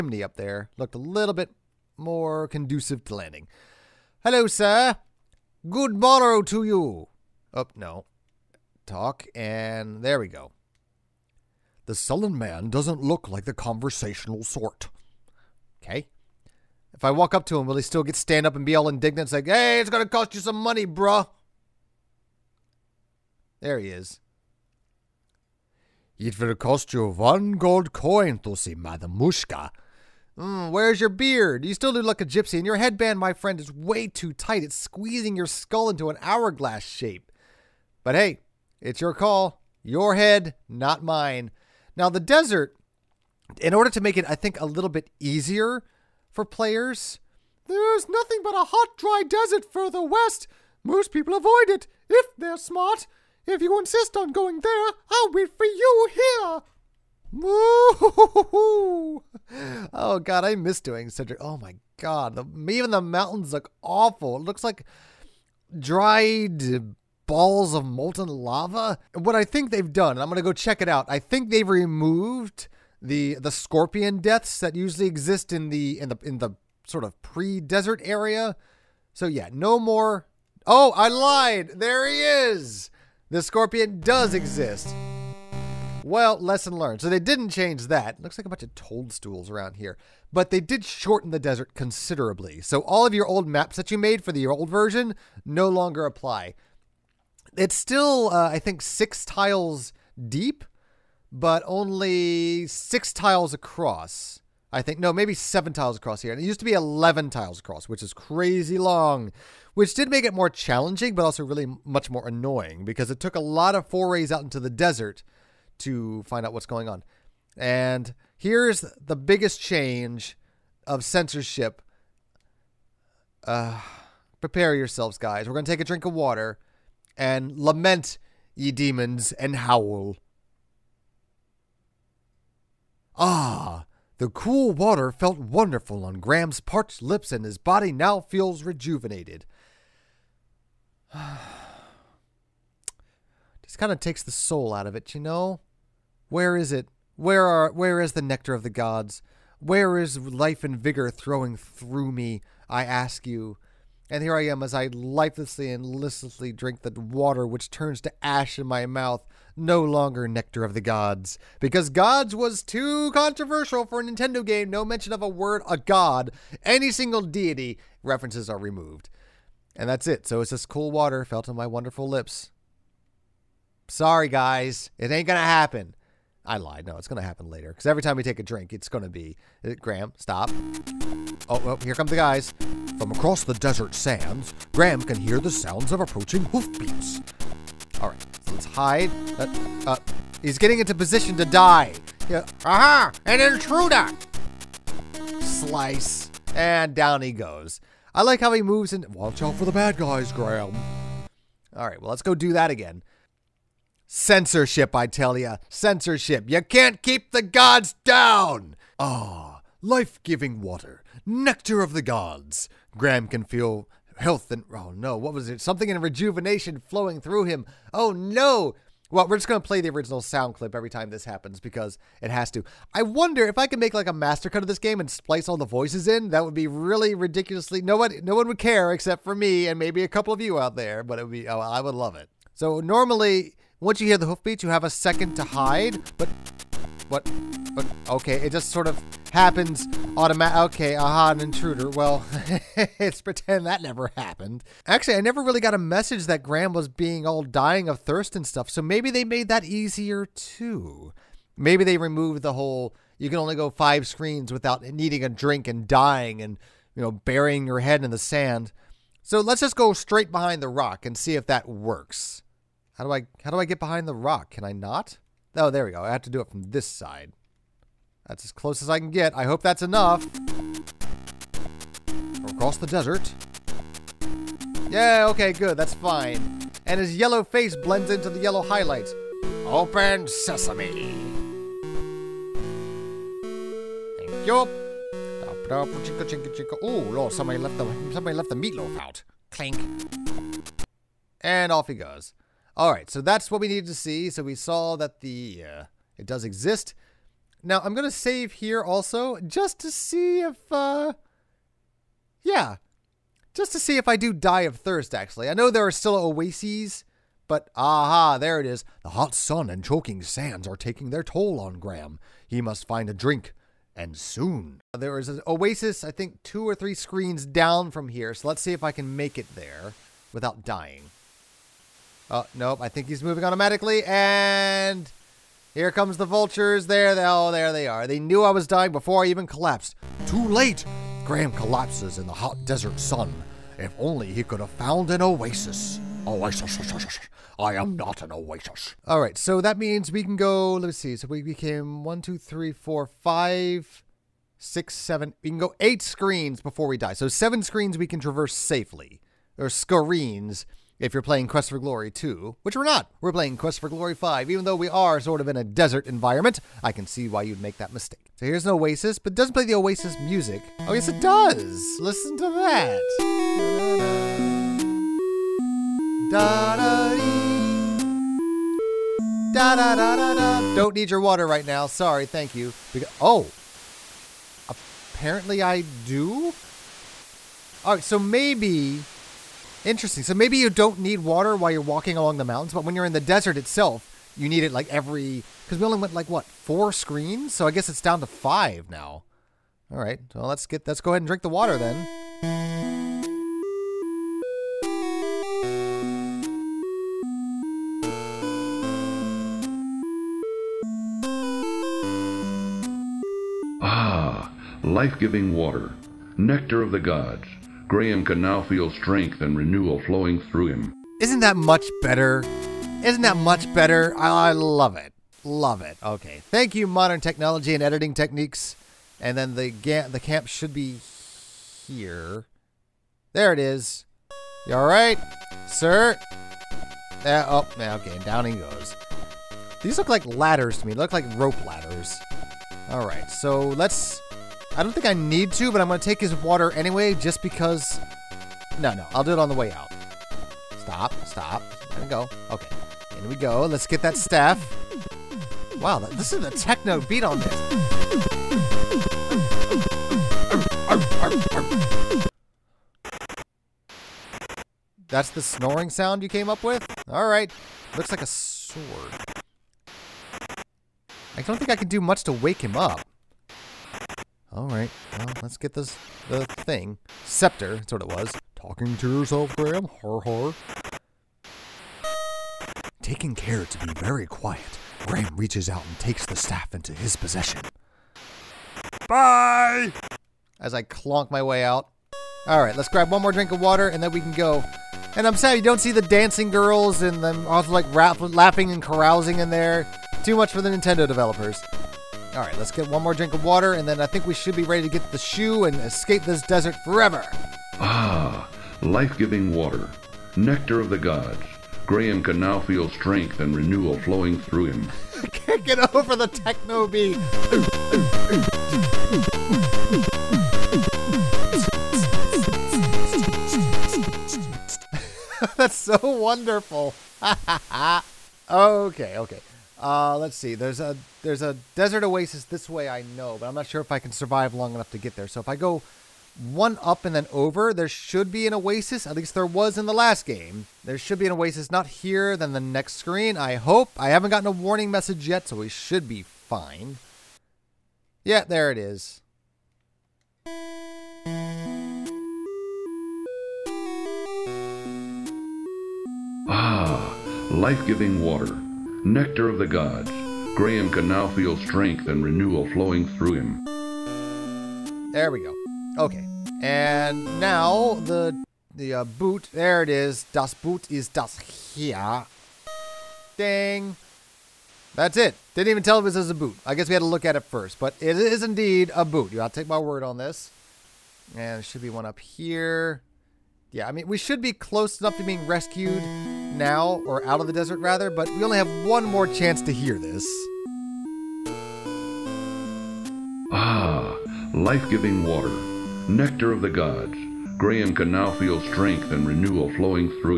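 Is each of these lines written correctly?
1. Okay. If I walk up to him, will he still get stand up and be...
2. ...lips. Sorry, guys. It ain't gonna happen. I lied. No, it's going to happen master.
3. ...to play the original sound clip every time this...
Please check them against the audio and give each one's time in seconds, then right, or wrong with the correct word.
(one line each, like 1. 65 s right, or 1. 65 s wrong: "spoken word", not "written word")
1. 15 s right
2. 172 s wrong: "later", not "master"
3. 219 s right.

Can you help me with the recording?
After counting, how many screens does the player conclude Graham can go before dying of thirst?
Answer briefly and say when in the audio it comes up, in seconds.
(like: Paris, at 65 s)
8, at 345 s.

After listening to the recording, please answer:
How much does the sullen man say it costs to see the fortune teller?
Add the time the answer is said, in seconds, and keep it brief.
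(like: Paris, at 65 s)
1 gold coin, at 27 s.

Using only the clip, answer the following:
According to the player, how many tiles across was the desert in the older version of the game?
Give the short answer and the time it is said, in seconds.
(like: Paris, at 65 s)
11, at 106 s.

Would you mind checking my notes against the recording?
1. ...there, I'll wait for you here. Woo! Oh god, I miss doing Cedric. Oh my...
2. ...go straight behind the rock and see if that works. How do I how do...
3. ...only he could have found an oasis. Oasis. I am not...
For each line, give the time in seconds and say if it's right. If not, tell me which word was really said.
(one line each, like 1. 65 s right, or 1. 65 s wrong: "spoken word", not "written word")
1. 54 s right
2. 259 s right
3. 333 s right.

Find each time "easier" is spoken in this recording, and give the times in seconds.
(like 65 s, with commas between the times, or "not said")
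45 s, 249 s.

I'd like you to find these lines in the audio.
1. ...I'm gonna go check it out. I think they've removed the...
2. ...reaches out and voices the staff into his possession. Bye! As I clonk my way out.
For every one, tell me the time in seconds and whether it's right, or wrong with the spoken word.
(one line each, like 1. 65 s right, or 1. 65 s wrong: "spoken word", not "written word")
1. 70 s right
2. 475 s wrong: "takes", not "voices".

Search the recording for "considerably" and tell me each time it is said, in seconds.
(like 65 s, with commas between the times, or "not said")
91 s.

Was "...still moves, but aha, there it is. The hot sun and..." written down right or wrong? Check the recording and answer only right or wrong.
wrong.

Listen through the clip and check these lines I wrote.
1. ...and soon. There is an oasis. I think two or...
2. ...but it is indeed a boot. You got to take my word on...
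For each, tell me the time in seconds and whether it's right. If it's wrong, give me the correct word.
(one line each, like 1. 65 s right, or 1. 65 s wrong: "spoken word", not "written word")
1. 313 s right
2. 567 s right.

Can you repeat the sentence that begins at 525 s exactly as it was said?
So if I go one up and then over, there should be an oasis.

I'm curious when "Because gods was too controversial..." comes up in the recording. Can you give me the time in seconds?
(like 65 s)
161 s.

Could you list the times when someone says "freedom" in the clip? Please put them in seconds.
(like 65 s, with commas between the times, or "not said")
not said.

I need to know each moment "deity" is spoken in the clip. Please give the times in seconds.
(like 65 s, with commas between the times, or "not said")
167 s.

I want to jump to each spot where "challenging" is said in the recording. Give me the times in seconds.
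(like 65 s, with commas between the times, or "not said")
110 s.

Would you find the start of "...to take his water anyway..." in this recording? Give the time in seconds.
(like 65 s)
435 s.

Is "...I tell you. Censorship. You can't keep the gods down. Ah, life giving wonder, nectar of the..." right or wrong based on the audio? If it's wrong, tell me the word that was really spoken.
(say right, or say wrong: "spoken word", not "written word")
wrong: "water", not "wonder".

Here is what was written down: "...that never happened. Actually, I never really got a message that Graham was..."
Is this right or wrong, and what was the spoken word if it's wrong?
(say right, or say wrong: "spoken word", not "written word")
right.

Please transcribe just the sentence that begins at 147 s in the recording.
Where are where is the nectar of the gods?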